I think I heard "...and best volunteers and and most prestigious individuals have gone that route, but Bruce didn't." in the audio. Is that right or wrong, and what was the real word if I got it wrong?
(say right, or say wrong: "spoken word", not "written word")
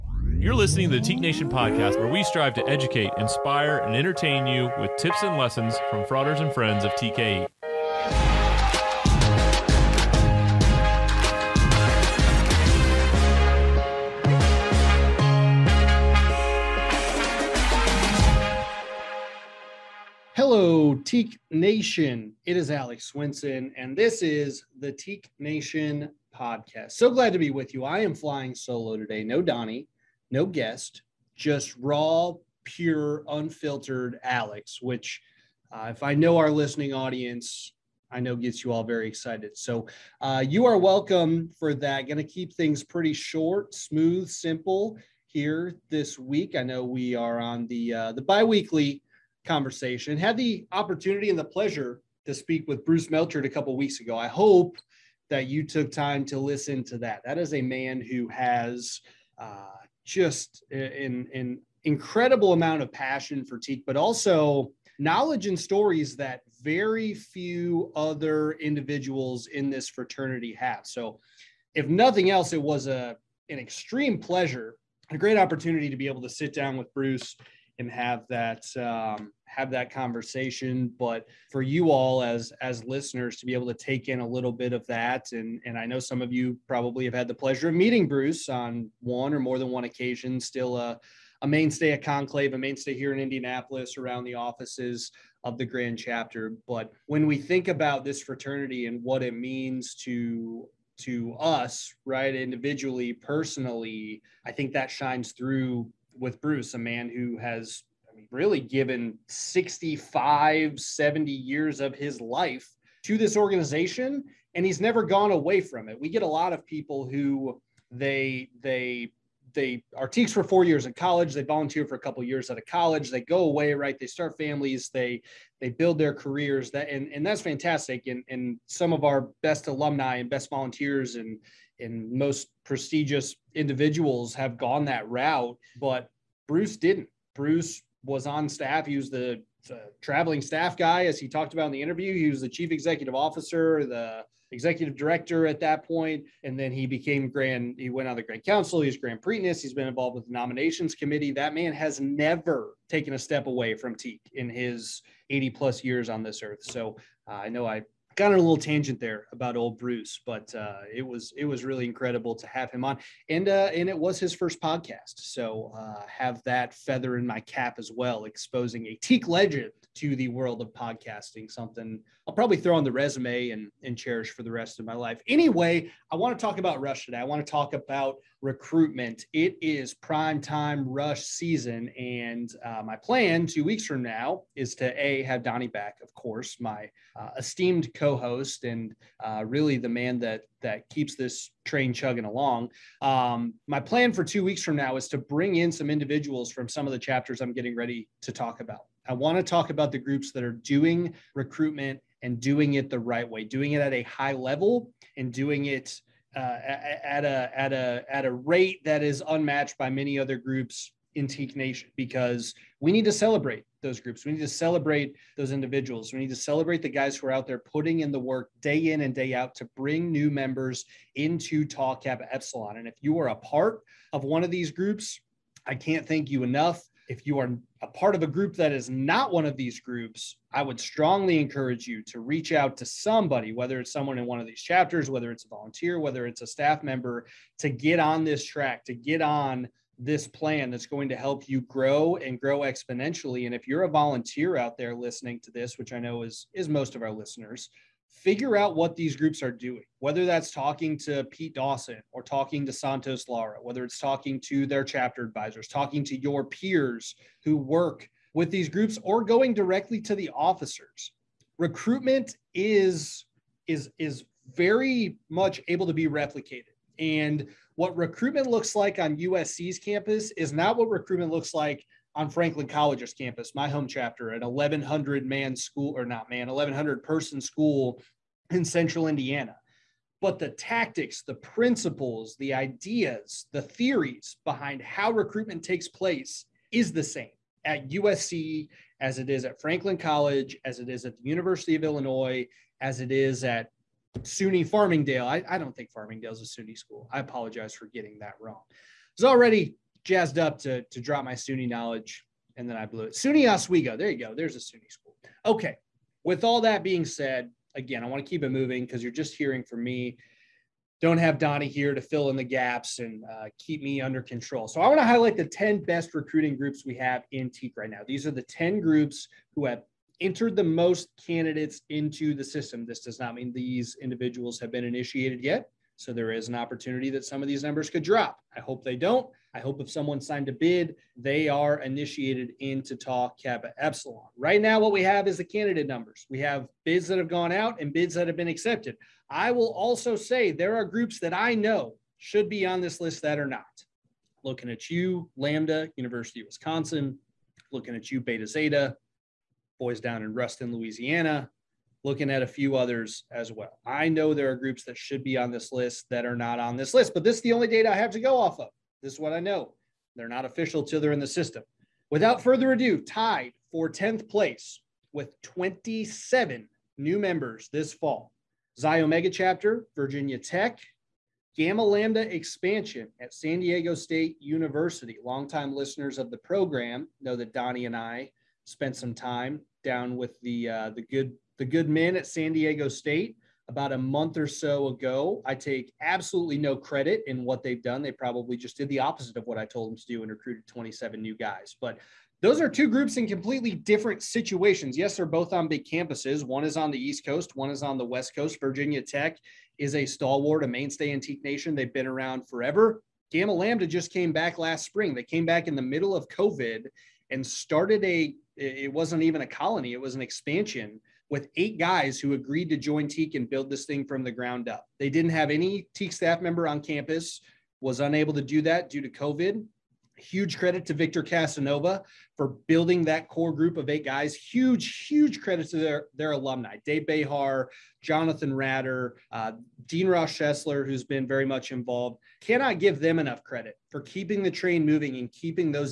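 right.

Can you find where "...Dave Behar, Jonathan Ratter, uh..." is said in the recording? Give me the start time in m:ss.
7:06.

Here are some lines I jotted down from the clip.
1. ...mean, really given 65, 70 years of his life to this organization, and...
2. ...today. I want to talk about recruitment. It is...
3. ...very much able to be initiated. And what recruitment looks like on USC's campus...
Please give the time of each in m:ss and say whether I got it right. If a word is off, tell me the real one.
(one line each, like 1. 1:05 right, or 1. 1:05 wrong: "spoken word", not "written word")
1. 1:48 right
2. 2:57 right
3. 4:24 wrong: "replicated", not "initiated".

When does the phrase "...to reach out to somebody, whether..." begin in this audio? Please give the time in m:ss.
3:52.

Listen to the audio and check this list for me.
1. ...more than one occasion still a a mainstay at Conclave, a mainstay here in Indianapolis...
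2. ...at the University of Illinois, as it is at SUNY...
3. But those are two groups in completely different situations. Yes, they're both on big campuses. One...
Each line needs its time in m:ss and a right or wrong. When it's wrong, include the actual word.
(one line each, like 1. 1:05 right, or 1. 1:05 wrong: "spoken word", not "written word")
1. 1:29 right
2. 4:51 right
3. 6:31 right.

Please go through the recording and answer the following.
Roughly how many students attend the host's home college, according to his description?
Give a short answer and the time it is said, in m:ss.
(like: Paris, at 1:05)
1,100, at 4:36.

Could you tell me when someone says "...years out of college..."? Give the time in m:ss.
2:02.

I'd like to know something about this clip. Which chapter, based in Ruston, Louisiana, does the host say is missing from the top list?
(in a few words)
Beta Zeta.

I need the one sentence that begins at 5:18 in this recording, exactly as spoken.
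These are the 10 groups who have entered the most candidates into the system.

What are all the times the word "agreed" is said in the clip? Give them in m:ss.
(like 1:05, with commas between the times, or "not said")
6:52.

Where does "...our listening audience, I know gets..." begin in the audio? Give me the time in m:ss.
0:36.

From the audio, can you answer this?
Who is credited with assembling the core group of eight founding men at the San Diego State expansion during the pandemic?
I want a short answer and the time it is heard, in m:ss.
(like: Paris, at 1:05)
Victor Casanova, at 7:00.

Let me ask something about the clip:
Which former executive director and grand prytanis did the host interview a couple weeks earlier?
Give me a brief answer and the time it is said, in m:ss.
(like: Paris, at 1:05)
Bruce Melchert, at 0:52.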